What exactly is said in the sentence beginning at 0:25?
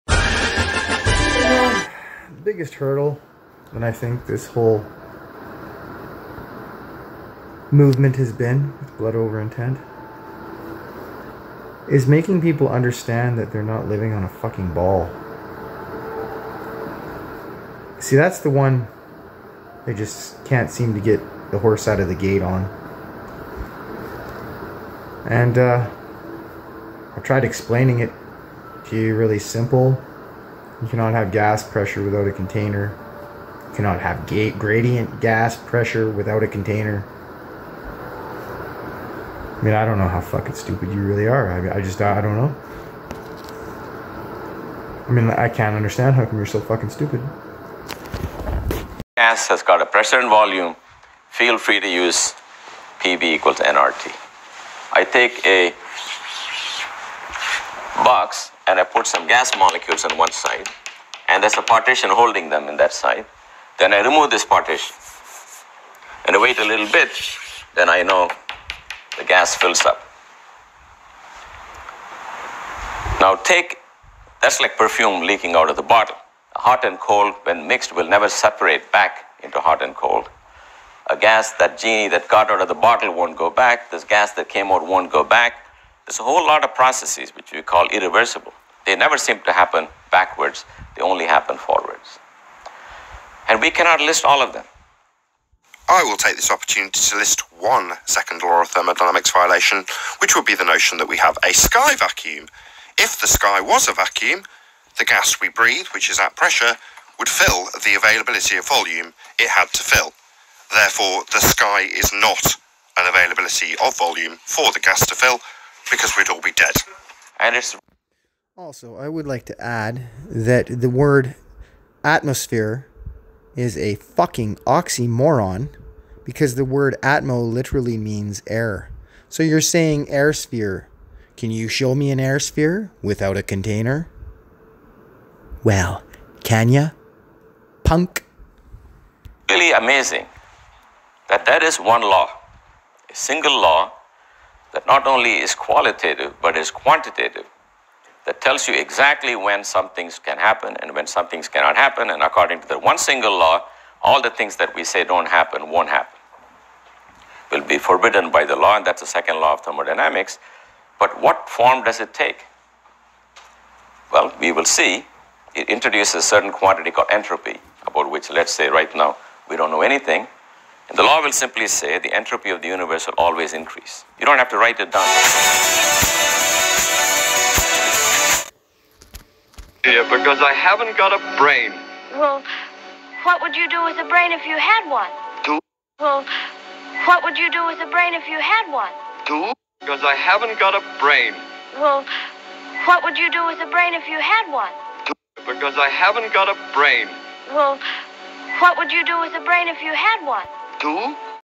And uh, I tried explaining it to you really simple you cannot have gas pressure without a container.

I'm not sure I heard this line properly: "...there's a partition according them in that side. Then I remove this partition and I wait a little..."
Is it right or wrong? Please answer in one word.
wrong.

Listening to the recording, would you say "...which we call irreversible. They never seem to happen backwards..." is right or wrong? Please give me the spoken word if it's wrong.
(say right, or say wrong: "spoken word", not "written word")
right.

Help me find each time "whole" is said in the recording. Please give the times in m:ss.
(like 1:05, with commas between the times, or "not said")
0:04, 1:26.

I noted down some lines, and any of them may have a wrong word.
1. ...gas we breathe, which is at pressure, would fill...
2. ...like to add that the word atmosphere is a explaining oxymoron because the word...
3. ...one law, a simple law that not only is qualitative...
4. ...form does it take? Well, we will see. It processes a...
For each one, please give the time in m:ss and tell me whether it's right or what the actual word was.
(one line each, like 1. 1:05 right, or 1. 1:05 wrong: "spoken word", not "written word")
1. 1:45 right
2. 1:59 wrong: "fucking", not "explaining"
3. 2:21 wrong: "single", not "simple"
4. 2:41 wrong: "introduces", not "processes".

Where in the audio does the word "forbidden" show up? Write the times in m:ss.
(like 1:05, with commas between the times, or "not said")
2:37.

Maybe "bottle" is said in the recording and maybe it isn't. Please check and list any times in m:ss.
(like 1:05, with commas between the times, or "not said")
1:15, 1:22.